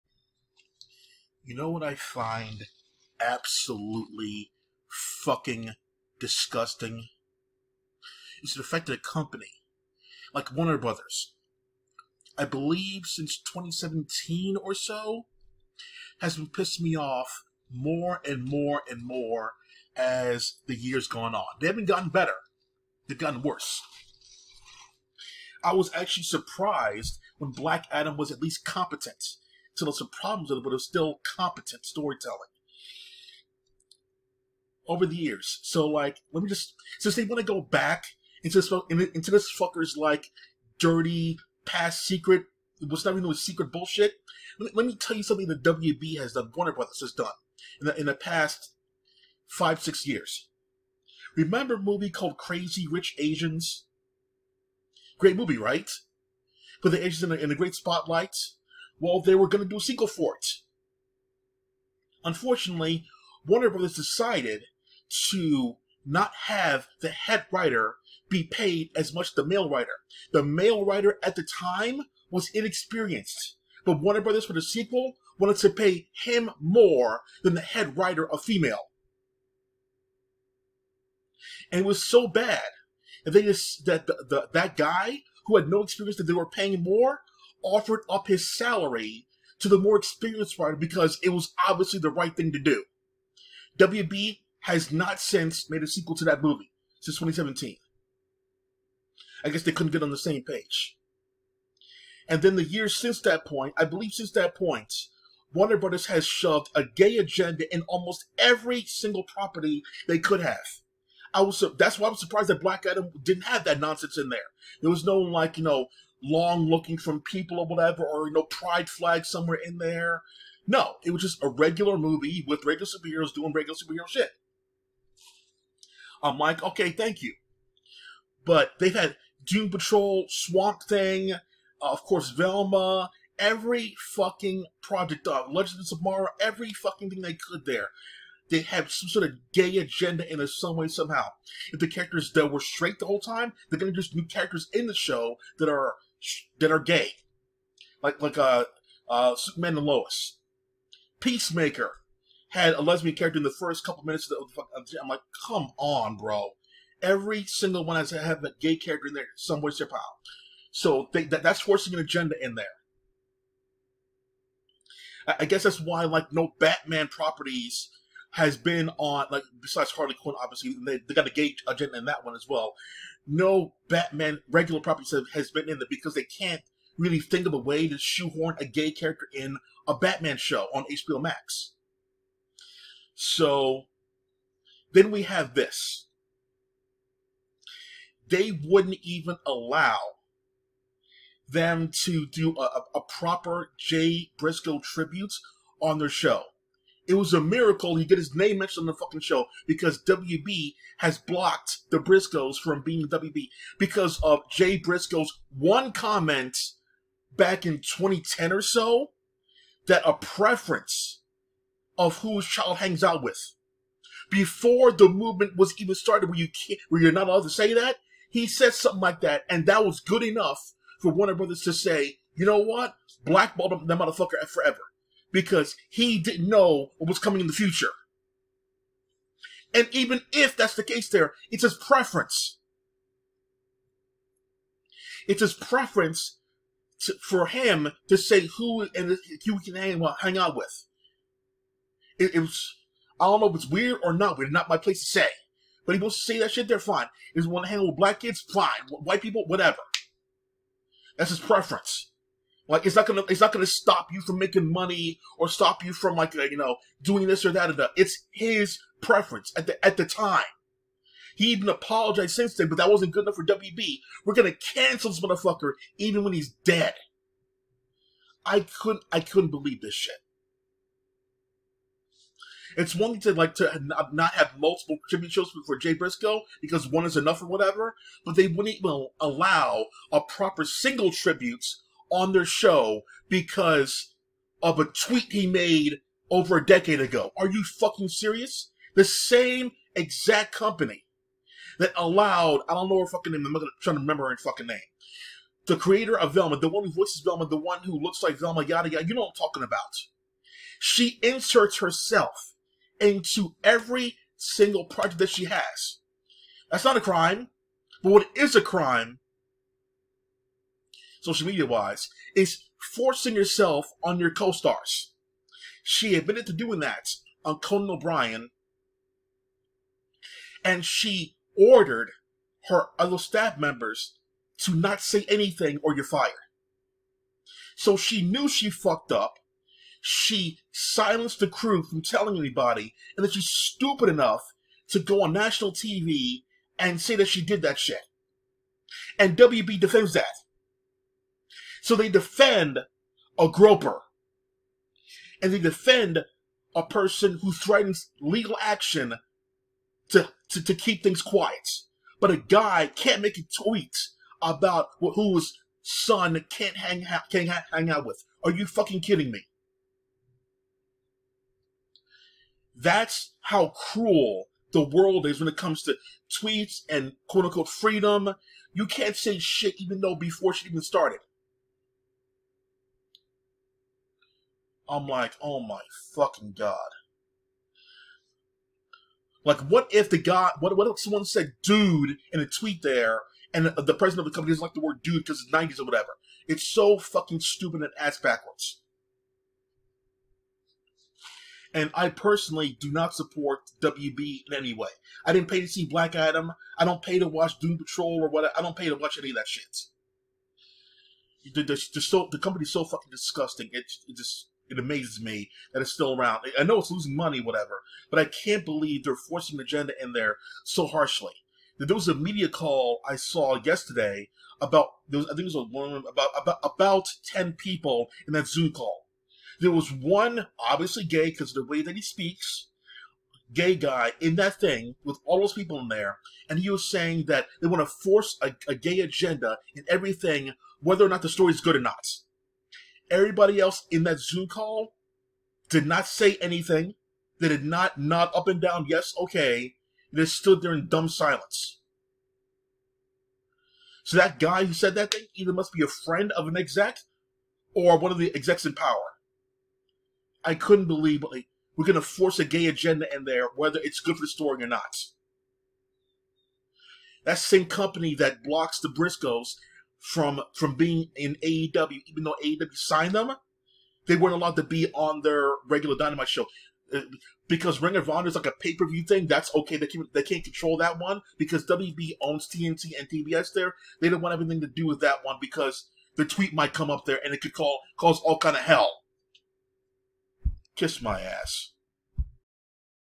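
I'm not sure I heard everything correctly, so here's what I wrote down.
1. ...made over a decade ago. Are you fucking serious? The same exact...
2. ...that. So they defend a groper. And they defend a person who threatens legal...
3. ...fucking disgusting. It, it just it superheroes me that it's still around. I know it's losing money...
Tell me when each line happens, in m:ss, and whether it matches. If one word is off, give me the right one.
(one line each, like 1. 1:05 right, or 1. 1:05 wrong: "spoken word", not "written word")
1. 4:45 right
2. 5:40 right
3. 6:42 wrong: "amazes", not "superheroes".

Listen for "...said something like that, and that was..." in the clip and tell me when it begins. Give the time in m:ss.
3:38.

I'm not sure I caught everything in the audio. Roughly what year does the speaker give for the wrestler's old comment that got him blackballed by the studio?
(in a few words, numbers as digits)
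2010.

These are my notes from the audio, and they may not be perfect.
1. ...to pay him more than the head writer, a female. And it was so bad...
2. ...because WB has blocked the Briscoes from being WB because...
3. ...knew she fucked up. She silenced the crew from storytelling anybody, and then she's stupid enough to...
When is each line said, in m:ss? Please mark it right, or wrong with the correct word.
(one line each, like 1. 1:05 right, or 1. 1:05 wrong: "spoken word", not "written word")
1. 1:15 right
2. 3:19 right
3. 5:28 wrong: "telling", not "storytelling".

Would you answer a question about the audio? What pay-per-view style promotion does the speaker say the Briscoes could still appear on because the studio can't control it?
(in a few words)
Ring of Honor.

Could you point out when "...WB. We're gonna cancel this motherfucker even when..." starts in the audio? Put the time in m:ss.
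4:23.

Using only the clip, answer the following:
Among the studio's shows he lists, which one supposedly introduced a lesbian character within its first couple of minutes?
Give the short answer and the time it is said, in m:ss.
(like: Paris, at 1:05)
Peacemaker, at 2:31.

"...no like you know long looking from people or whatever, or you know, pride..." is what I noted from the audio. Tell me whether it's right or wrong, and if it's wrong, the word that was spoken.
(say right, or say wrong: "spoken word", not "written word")
right.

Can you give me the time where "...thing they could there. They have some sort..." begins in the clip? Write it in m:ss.
2:17.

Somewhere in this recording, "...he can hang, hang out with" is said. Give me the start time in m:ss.
3:59.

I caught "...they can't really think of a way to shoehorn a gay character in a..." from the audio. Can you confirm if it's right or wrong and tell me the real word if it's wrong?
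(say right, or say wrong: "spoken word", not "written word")
right.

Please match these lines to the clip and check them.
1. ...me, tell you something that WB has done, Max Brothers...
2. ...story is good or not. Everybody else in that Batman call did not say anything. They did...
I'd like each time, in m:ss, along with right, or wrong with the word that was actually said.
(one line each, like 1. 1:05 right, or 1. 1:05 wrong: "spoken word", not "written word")
1. 0:44 wrong: "Warner", not "Max"
2. 7:11 wrong: "Zoom", not "Batman".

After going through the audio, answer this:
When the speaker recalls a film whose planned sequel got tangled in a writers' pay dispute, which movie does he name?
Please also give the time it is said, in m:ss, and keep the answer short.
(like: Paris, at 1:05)
Crazy Rich Asians, at 0:52.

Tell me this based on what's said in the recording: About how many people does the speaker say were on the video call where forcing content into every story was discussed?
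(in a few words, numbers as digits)
10.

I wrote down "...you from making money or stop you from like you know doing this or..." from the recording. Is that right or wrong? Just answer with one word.
right.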